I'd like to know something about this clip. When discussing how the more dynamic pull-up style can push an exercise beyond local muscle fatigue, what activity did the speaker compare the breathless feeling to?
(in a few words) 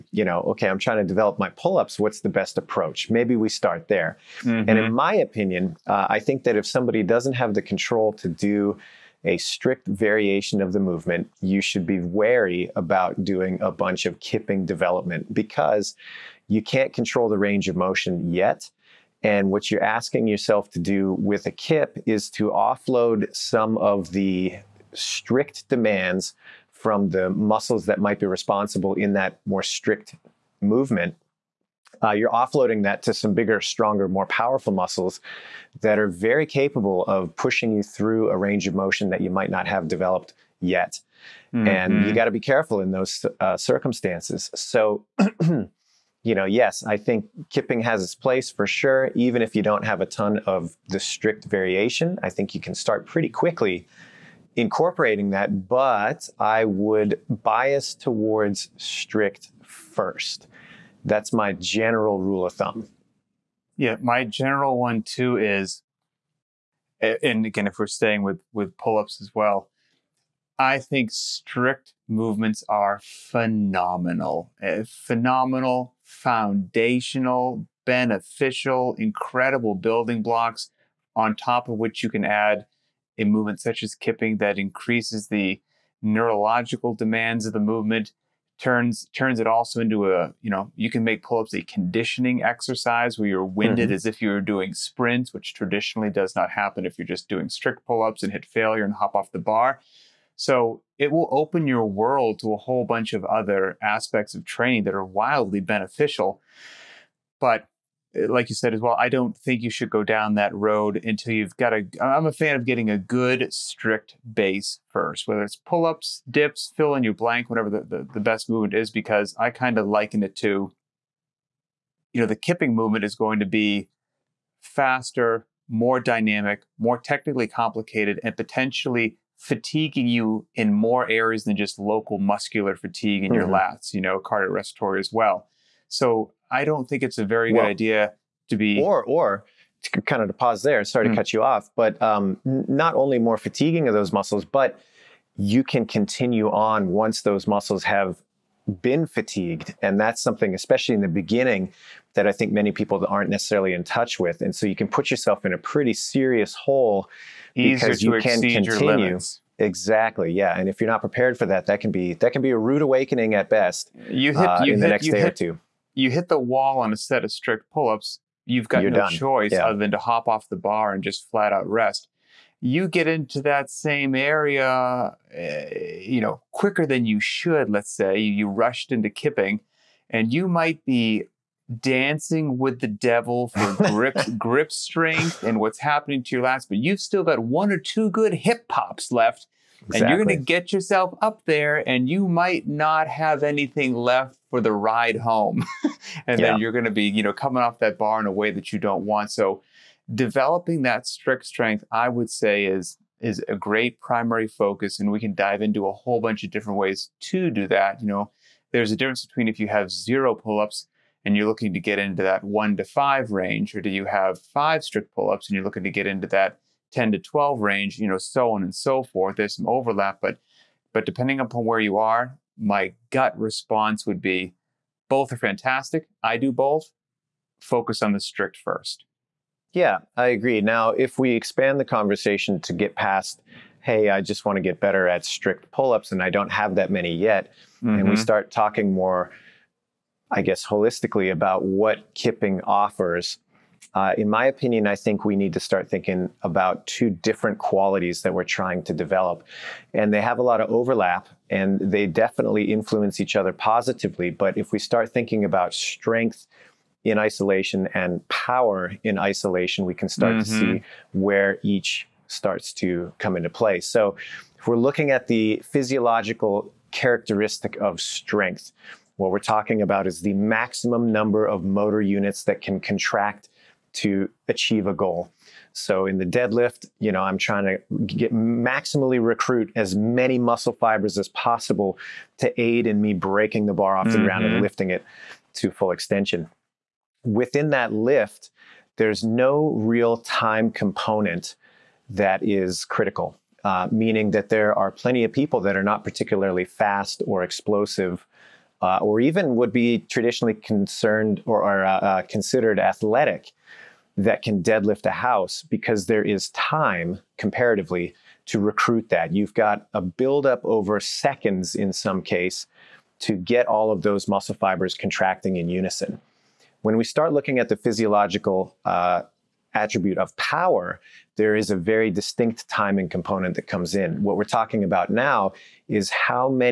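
Sprints.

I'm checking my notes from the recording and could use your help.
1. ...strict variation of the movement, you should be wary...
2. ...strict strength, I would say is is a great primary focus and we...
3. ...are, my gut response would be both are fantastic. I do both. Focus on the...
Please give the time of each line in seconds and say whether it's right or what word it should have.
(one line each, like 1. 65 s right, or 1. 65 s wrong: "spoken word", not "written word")
1. 9 s right
2. 201 s right
3. 221 s right.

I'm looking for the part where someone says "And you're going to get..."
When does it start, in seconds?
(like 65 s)
190 s.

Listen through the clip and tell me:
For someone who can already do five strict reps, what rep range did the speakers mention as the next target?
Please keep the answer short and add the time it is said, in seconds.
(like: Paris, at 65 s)
10 to 12, at 216 s.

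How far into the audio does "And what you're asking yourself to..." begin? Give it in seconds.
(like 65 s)
19 s.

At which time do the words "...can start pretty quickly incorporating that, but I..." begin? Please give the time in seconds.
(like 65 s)
52 s.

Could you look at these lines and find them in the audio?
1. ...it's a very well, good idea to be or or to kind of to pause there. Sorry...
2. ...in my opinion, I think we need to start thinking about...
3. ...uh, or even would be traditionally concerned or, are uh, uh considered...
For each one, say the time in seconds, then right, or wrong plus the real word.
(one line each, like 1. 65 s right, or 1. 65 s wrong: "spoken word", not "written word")
1. 137 s right
2. 244 s right
3. 298 s right.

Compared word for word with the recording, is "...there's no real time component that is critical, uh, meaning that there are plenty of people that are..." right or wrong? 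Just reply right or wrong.
right.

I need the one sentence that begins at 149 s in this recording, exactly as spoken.
And that's something, especially in the beginning, that I think many people aren't necessarily in touch with.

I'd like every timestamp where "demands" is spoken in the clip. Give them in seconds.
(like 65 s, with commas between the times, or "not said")
25 s, 86 s.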